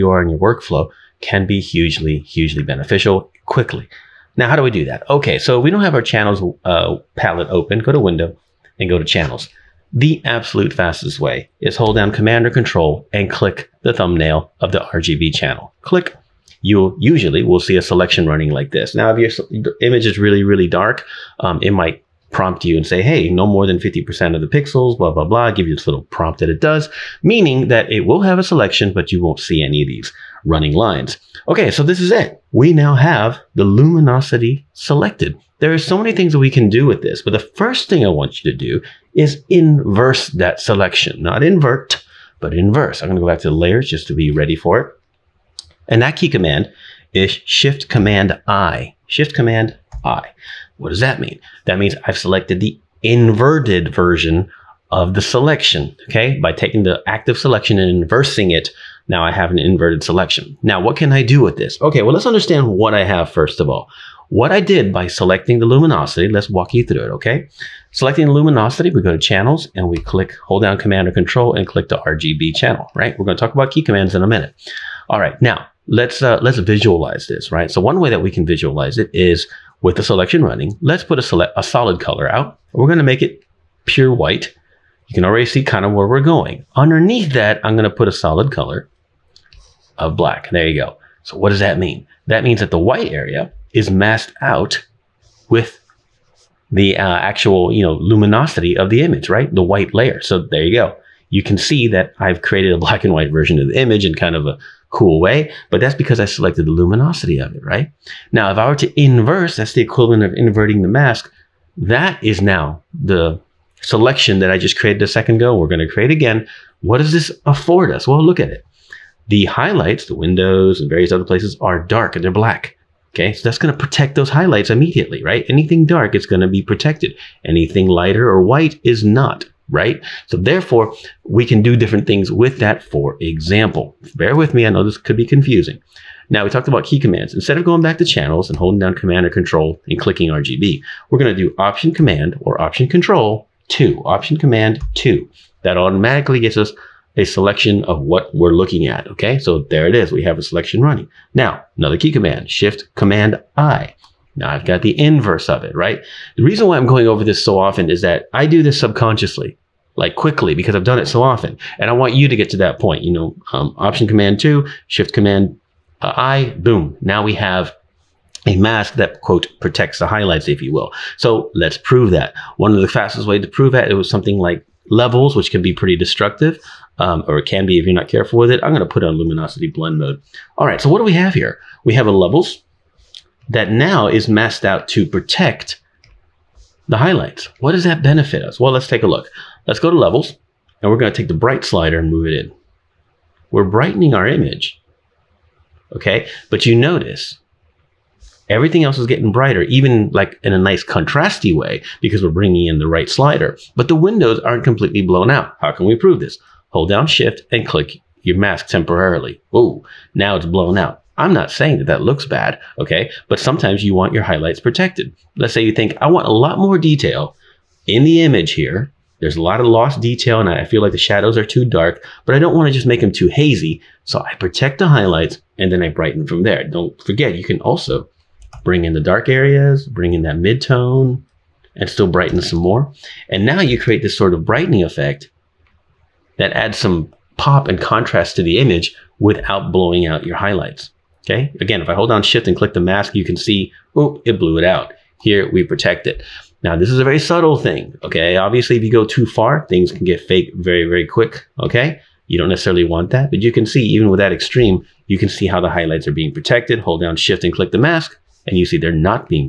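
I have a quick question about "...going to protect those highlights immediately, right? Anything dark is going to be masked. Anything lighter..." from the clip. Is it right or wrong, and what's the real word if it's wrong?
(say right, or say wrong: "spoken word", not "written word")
wrong: "protected", not "masked".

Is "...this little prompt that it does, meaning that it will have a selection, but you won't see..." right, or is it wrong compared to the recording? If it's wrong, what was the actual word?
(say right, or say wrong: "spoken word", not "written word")
right.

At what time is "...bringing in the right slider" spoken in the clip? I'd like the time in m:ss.
3:22.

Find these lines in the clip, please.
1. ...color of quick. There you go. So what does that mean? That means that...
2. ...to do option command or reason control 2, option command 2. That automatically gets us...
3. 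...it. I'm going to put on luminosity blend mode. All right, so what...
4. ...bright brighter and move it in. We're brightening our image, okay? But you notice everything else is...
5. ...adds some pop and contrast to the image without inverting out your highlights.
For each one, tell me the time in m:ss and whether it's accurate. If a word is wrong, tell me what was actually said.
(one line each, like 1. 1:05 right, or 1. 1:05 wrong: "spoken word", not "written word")
1. 1:28 wrong: "black", not "quick"
2. 2:21 wrong: "option", not "reason"
3. 2:58 right
4. 3:11 wrong: "slider", not "brighter"
5. 3:56 wrong: "blowing", not "inverting".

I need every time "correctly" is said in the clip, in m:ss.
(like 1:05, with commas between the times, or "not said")
not said.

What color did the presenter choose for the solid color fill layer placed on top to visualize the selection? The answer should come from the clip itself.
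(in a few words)
Pure white.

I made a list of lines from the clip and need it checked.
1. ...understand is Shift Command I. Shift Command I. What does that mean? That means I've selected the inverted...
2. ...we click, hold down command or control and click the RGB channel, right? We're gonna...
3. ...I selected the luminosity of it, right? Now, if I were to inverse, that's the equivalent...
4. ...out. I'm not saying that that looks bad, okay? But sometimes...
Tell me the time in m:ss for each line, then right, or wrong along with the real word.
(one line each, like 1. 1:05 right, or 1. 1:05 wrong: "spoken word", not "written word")
1. 0:46 wrong: "command", not "understand"
2. 1:09 right
3. 1:46 right
4. 3:30 right.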